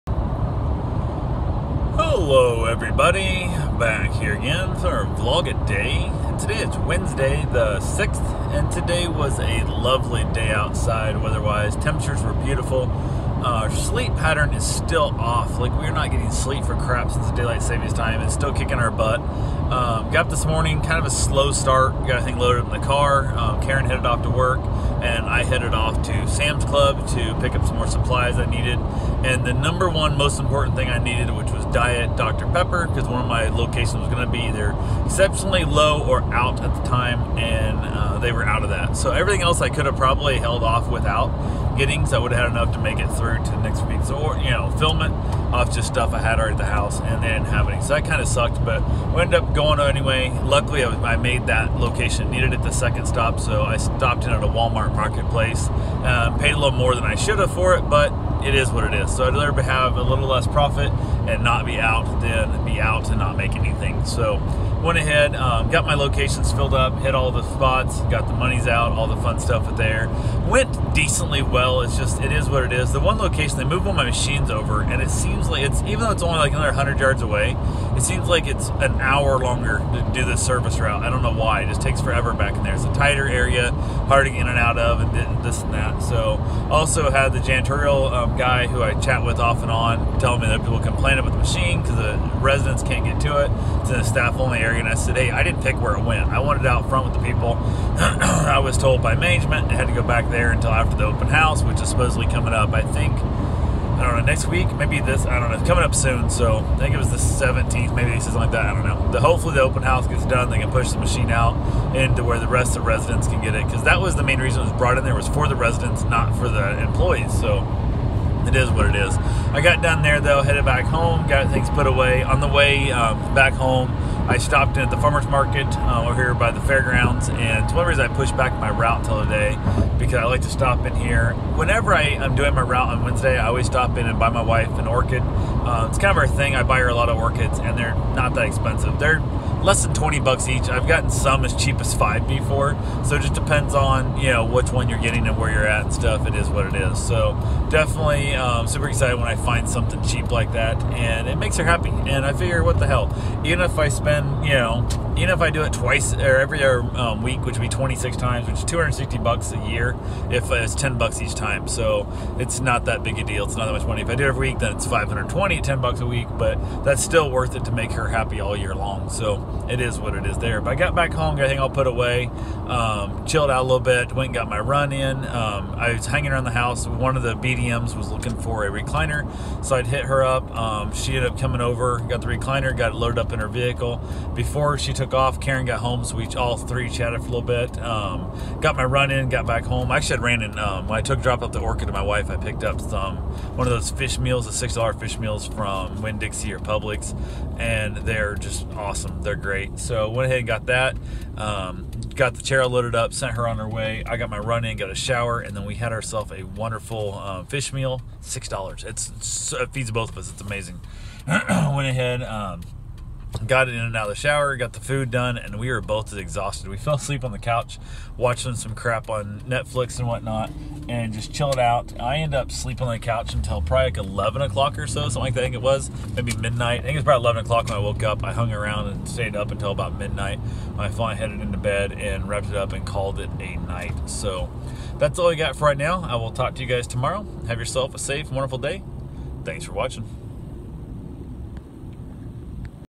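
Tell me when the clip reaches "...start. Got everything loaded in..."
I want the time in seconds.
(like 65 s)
21 s.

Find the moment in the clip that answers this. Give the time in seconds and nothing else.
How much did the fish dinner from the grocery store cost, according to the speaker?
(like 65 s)
194 s.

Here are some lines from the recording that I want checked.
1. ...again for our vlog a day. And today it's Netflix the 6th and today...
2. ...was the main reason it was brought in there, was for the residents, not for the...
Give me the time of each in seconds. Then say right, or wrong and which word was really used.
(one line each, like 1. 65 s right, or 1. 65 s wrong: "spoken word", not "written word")
1. 4 s wrong: "Wednesday", not "Netflix"
2. 114 s right.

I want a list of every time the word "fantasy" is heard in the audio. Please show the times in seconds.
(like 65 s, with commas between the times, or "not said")
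not said.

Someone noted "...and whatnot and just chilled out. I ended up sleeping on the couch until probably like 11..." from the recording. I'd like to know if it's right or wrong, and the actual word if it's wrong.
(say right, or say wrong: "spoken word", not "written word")
right.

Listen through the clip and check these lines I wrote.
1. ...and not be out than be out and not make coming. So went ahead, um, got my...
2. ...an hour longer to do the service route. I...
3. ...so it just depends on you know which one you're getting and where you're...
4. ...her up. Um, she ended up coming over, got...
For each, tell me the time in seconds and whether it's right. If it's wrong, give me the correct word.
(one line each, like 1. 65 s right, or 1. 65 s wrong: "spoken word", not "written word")
1. 61 s wrong: "anything", not "coming"
2. 78 s right
3. 143 s right
4. 180 s right.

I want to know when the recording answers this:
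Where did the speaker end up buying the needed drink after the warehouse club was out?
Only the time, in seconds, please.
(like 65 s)
54 s.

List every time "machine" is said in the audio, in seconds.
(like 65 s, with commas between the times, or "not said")
74 s, 91 s, 110 s.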